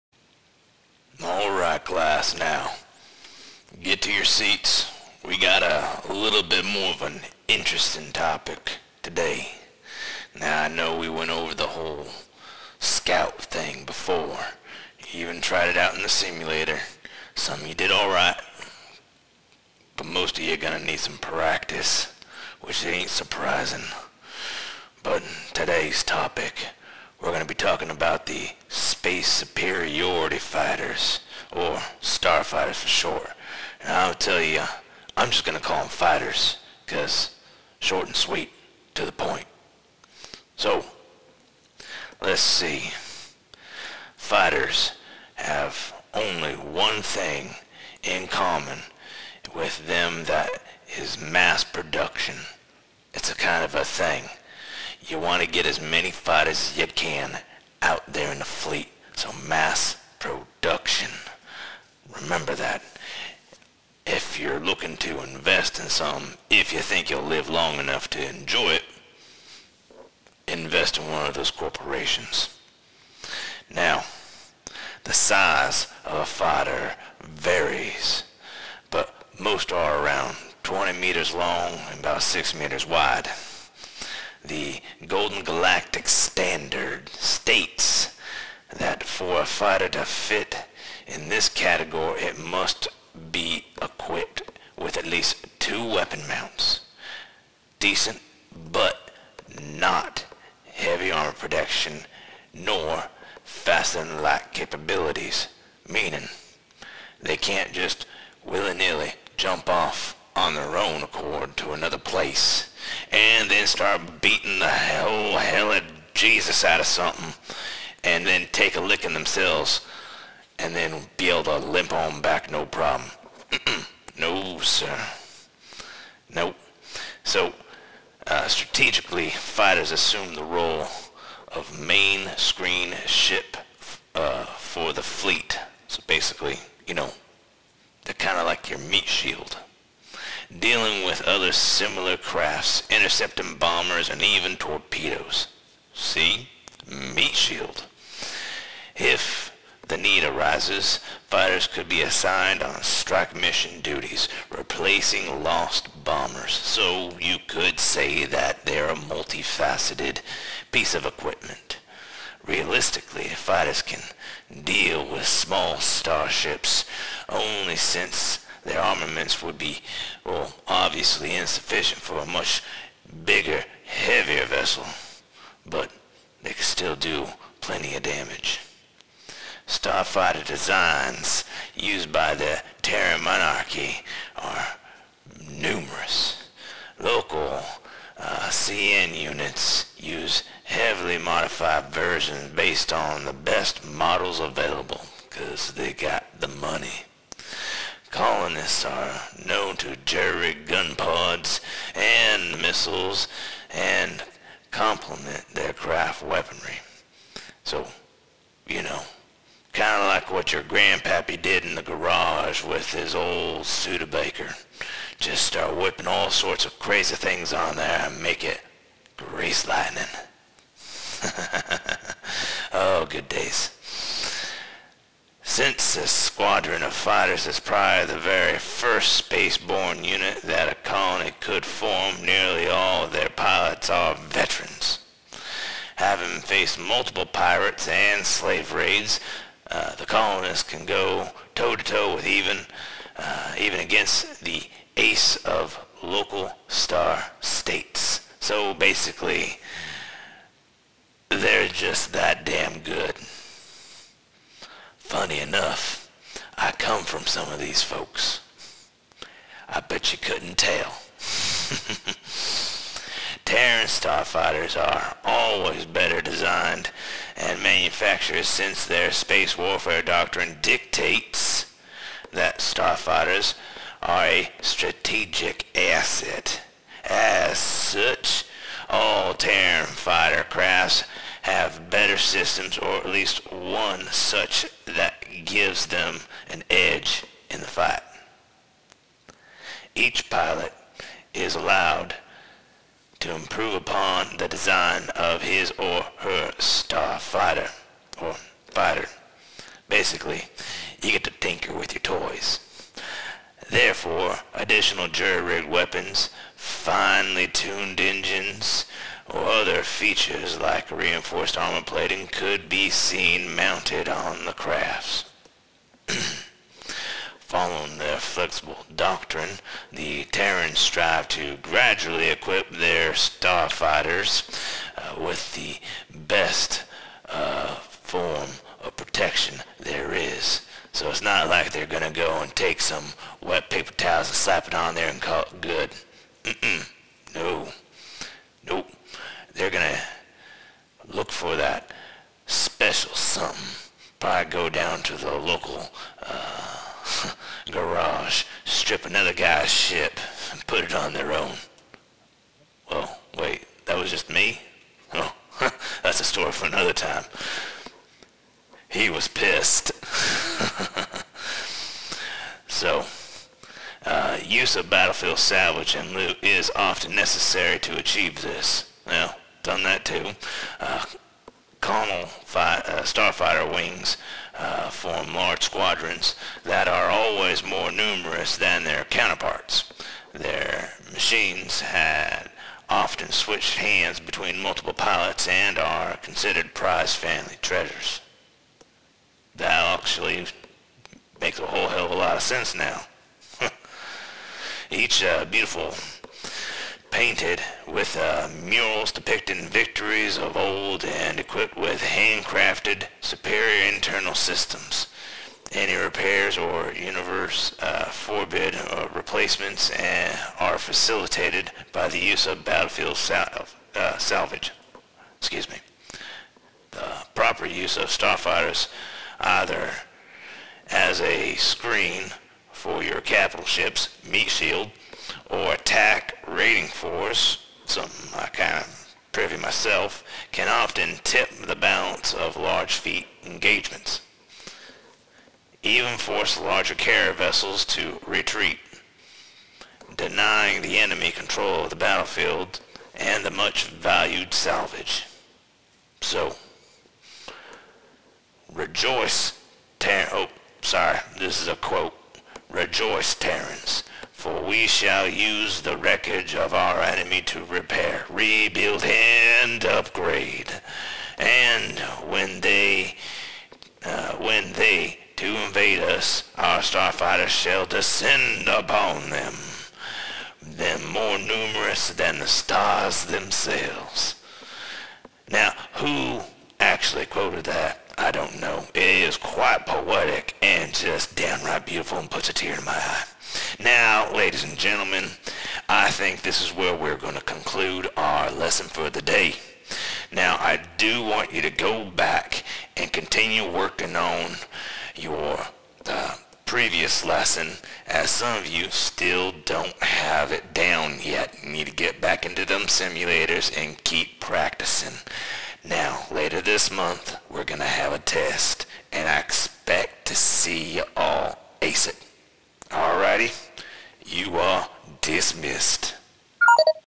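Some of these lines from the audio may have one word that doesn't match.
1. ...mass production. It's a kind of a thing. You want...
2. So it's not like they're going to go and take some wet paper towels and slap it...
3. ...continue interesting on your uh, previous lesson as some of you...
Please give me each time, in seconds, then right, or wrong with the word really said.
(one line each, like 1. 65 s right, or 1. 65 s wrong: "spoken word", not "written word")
1. 51 s right
2. 330 s right
3. 493 s wrong: "working", not "interesting".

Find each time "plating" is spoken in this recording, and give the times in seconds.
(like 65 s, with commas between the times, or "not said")
311 s.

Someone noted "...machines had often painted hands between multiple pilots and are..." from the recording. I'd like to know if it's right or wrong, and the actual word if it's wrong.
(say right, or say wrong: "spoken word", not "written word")
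wrong: "switched", not "painted".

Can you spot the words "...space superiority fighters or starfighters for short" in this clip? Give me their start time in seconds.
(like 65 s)
28 s.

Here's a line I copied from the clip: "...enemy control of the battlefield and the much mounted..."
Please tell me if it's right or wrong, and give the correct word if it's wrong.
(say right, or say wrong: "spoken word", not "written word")
wrong: "valued", not "mounted".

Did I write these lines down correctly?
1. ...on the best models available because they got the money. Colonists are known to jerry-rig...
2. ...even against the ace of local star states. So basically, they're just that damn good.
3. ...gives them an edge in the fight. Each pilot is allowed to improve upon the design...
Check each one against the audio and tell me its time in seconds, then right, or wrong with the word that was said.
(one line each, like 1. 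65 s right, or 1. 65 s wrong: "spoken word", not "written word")
1. 192 s right
2. 243 s right
3. 285 s right.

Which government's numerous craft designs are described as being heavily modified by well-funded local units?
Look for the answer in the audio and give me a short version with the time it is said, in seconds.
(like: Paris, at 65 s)
Terran monarchy, at 182 s.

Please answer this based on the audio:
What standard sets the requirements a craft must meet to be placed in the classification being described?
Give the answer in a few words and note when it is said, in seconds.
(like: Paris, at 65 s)
Golden Galactic Standard, at 85 s.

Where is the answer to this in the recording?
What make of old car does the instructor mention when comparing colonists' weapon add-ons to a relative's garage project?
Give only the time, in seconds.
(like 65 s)
213 s.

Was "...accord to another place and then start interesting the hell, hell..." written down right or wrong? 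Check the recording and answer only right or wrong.
wrong.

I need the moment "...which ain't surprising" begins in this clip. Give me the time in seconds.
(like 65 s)
22 s.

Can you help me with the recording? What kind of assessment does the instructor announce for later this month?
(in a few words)
a test.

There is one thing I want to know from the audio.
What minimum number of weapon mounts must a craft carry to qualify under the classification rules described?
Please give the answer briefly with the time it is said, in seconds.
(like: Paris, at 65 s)
2, at 94 s.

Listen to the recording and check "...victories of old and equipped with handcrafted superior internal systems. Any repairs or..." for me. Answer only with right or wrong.
right.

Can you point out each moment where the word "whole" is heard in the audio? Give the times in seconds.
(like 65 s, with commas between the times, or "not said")
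11 s, 391 s.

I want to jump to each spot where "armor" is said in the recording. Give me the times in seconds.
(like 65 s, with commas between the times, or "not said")
101 s, 311 s.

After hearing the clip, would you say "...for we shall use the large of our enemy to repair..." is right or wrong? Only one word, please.
wrong.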